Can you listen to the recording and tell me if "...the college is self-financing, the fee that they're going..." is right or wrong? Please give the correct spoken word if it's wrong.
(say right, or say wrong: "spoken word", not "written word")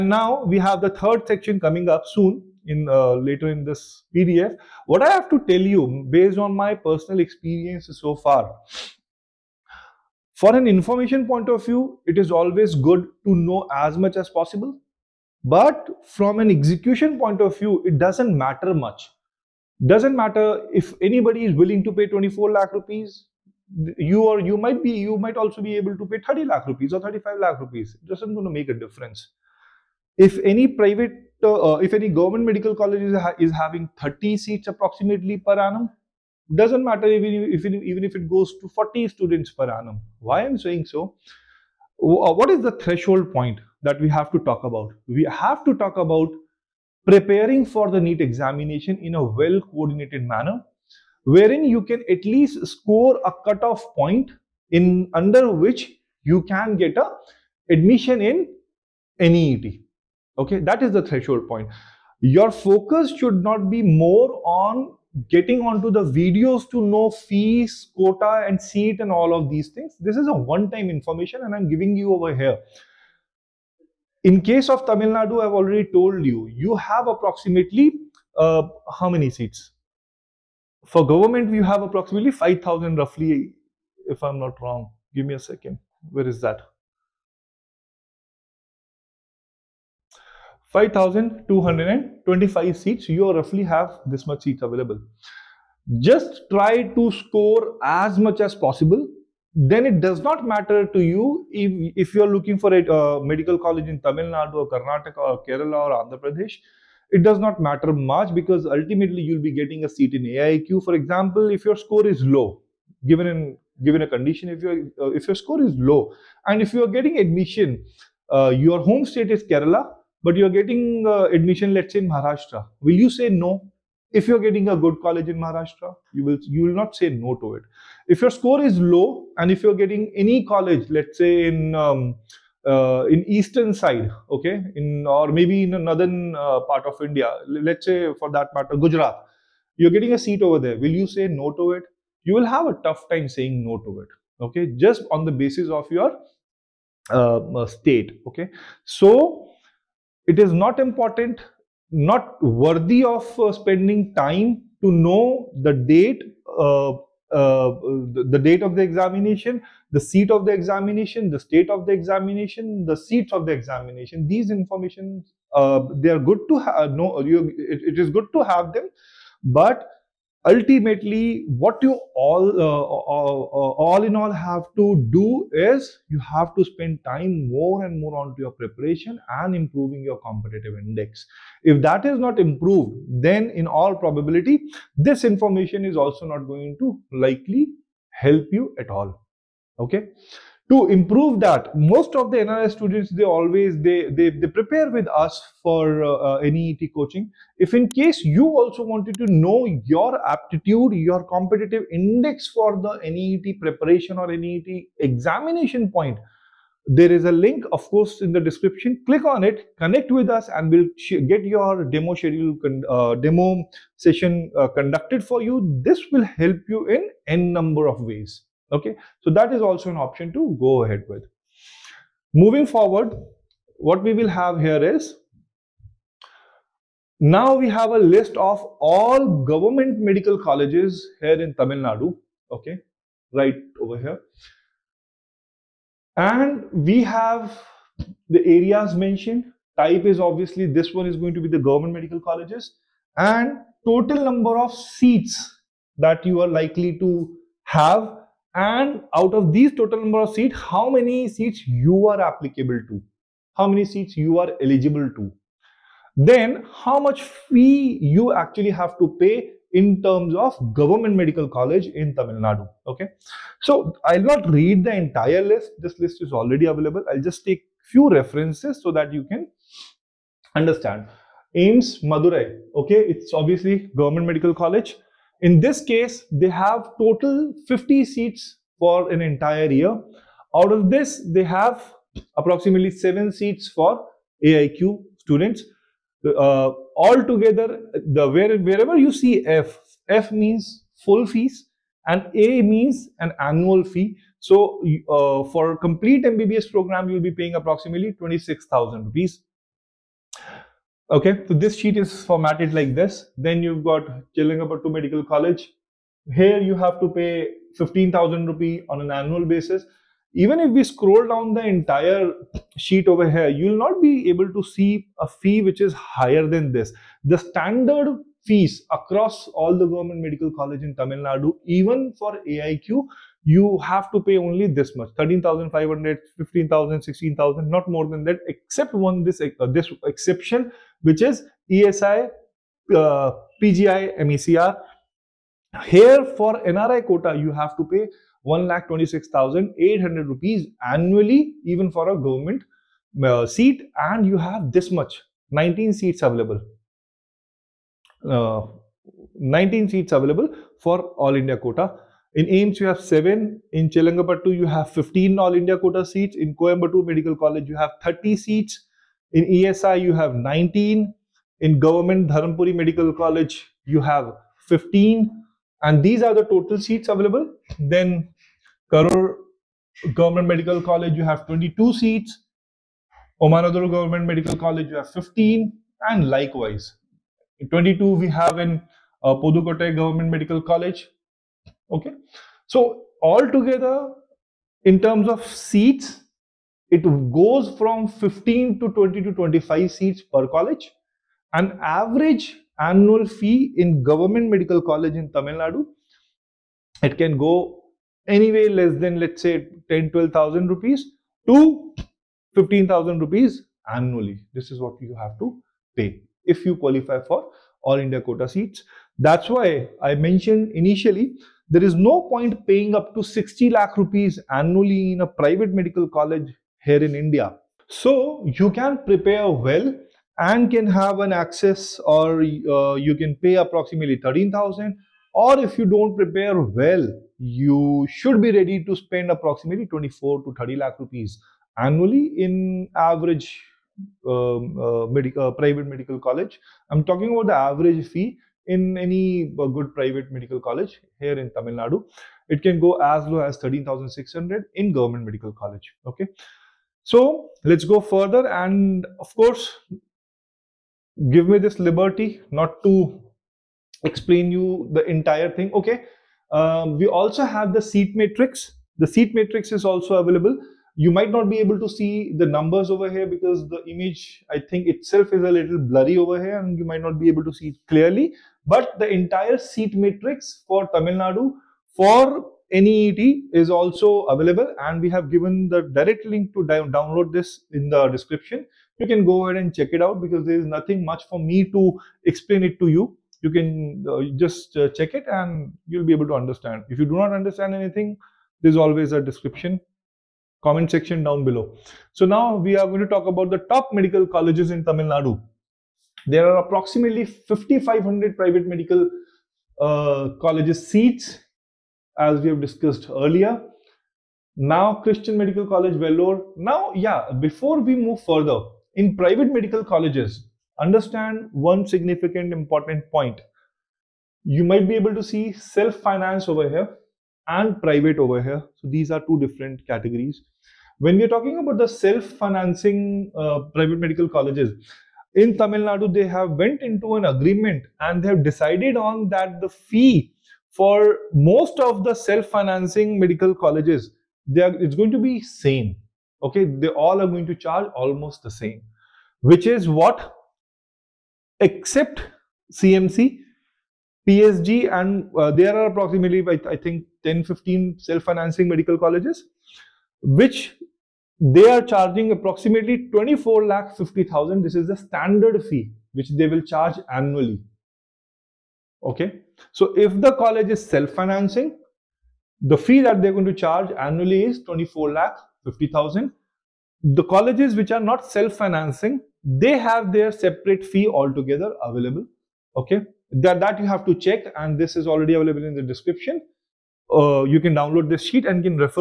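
right.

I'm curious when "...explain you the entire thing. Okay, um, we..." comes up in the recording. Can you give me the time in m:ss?
7:34.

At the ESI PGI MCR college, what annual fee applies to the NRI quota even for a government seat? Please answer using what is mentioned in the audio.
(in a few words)
1,26,800 rupees.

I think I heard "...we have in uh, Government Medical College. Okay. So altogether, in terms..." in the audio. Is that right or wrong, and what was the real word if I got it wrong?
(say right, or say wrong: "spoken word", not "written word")
right.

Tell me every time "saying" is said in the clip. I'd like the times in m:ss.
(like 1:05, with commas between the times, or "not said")
0:40, 2:23.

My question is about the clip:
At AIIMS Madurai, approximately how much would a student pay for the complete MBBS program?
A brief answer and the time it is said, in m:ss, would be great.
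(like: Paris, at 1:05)
26,000 rupees, at 4:58.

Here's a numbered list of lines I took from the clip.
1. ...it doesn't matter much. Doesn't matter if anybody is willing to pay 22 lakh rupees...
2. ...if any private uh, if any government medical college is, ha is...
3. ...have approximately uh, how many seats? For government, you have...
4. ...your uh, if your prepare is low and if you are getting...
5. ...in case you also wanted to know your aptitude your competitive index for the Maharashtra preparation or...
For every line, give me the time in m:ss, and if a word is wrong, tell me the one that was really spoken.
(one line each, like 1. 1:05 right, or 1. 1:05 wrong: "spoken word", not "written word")
1. 0:17 wrong: "24", not "22"
2. 0:30 right
3. 1:16 right
4. 1:54 wrong: "score", not "prepare"
5. 3:17 wrong: "NEET", not "Maharashtra".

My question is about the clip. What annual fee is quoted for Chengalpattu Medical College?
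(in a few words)
15,000 rupees.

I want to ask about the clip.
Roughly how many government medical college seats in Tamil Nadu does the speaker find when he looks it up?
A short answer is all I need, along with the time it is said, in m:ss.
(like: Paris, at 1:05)
5,225, at 1:30.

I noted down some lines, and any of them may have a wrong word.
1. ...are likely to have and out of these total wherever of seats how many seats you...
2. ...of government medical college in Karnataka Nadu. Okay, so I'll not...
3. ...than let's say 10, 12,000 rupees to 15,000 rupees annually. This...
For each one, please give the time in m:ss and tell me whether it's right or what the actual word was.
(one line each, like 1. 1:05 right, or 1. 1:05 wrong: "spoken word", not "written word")
1. 4:06 wrong: "number", not "wherever"
2. 4:20 wrong: "Tamil", not "Karnataka"
3. 6:38 right.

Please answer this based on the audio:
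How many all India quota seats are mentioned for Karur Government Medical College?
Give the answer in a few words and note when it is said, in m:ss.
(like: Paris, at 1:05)
22, at 6:11.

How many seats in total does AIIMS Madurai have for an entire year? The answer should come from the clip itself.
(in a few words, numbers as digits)
50.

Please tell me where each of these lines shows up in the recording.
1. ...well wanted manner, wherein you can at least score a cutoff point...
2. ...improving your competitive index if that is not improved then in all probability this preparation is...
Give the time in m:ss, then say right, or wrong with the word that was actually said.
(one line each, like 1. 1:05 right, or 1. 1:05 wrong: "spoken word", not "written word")
1. 0:49 wrong: "coordinated", not "wanted"
2. 2:59 wrong: "information", not "preparation".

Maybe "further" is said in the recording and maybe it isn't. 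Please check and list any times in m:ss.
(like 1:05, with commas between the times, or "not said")
7:28, 8:28.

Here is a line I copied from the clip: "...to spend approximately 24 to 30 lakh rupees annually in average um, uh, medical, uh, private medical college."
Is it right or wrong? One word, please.
right.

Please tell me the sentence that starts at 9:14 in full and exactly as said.
This is the standard fee which they will charge annually.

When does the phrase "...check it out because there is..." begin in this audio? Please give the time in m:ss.
7:59.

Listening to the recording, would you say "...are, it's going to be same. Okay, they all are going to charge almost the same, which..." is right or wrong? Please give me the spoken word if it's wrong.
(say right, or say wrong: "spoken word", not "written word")
right.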